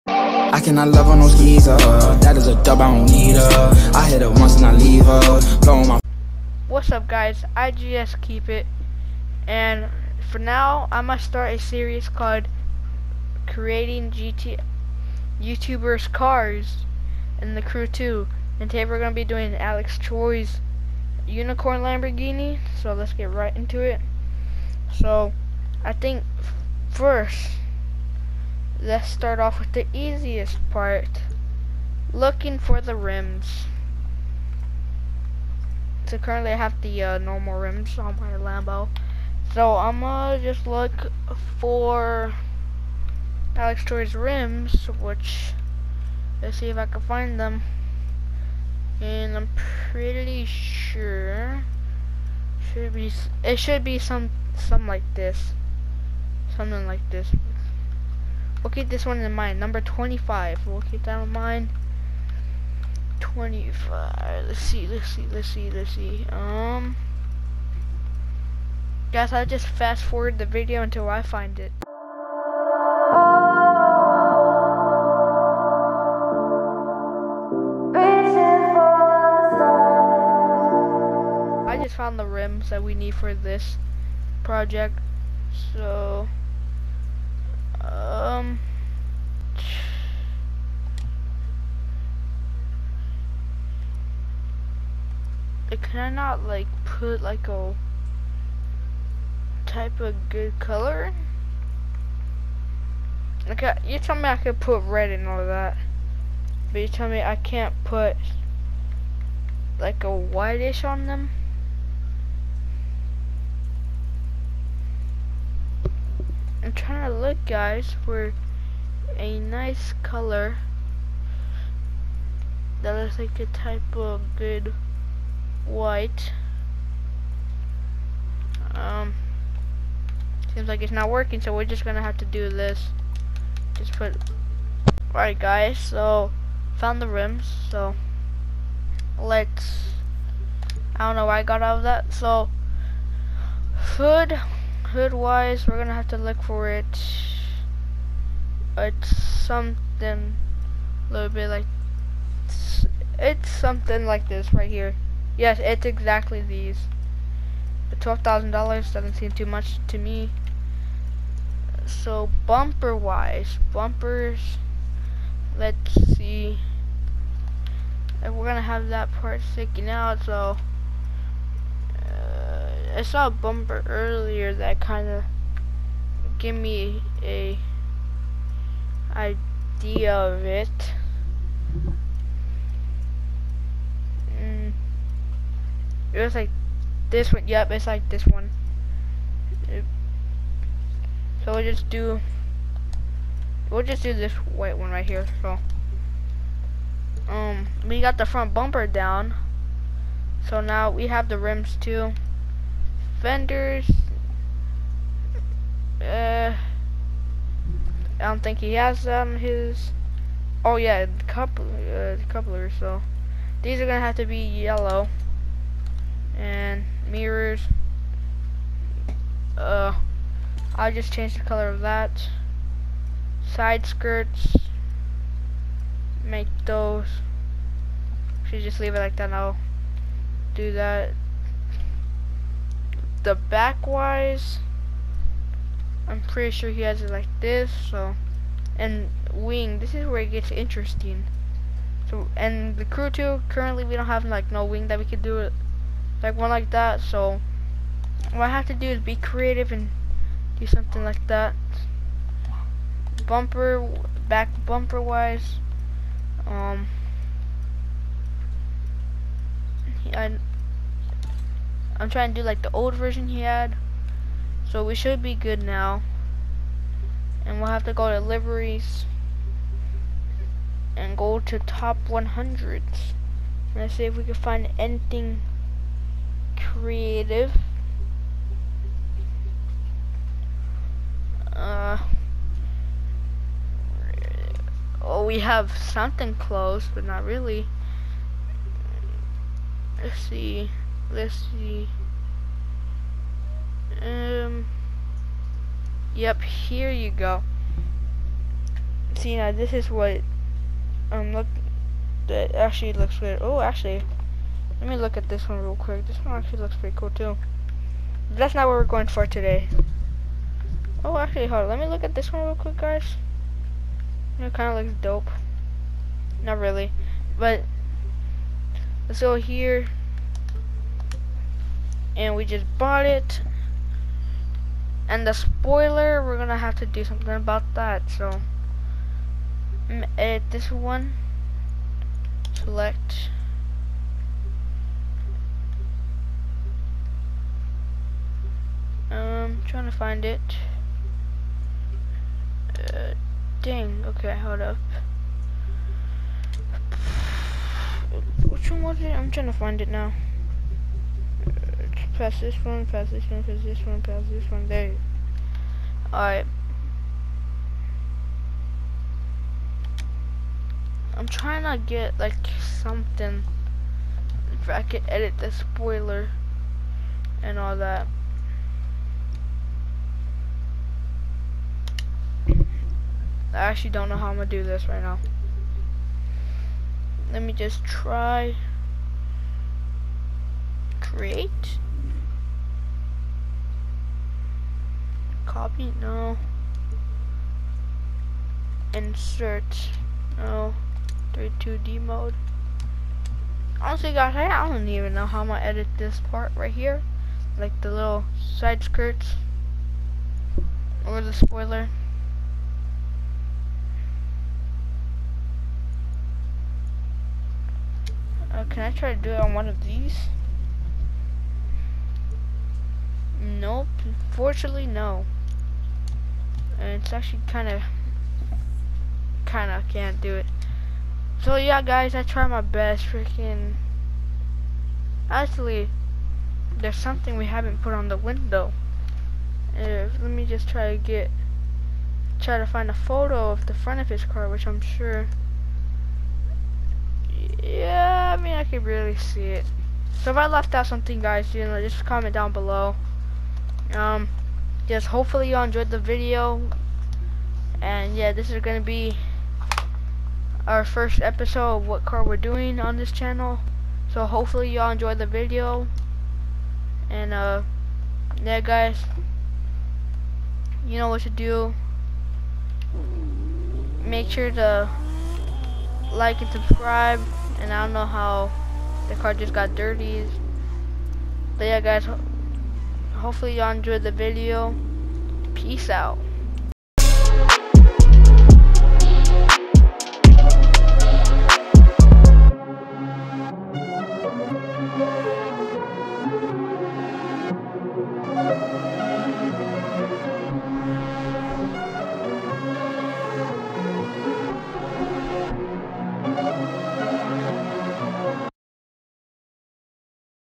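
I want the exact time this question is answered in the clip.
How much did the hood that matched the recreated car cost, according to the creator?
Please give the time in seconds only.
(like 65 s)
157 s.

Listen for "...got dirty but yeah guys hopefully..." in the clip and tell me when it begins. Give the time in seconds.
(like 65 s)
469 s.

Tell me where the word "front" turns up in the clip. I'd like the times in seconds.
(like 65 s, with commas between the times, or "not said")
198 s, 433 s.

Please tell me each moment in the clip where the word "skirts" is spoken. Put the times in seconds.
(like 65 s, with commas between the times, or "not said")
223 s, 398 s.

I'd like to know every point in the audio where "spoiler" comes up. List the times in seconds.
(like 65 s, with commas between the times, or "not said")
325 s, 365 s, 401 s.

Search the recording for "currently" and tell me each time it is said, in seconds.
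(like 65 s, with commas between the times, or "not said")
36 s, 243 s.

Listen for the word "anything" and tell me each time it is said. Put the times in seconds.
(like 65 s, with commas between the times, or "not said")
274 s.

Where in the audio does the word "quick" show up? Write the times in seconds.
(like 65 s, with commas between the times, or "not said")
305 s, 312 s.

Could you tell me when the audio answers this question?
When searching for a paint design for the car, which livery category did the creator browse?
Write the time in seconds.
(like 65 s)
271 s.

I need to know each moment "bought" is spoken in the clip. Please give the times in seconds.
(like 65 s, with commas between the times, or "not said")
322 s.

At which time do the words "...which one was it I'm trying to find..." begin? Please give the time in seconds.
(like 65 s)
348 s.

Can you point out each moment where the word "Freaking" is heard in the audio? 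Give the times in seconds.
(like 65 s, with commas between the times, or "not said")
423 s.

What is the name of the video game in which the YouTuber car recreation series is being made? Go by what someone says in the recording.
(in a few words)
The Crew 2.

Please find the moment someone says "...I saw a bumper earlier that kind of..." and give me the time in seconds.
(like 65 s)
173 s.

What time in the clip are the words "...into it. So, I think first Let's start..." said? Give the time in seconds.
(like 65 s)
23 s.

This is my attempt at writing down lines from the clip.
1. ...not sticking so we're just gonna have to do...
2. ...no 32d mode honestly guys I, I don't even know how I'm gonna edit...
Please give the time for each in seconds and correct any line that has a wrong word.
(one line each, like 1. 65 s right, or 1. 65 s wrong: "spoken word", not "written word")
1. 130 s wrong: "working", not "sticking"
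2. 390 s right.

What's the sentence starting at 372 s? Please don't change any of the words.
I actually don't know how I'm gonna do this right now.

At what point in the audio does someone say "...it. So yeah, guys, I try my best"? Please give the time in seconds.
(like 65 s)
420 s.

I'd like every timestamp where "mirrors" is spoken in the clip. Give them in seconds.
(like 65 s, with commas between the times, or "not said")
217 s.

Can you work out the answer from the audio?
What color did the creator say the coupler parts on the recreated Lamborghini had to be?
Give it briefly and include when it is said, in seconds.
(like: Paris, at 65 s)
Yellow, at 214 s.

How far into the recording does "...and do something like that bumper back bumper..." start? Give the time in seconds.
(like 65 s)
249 s.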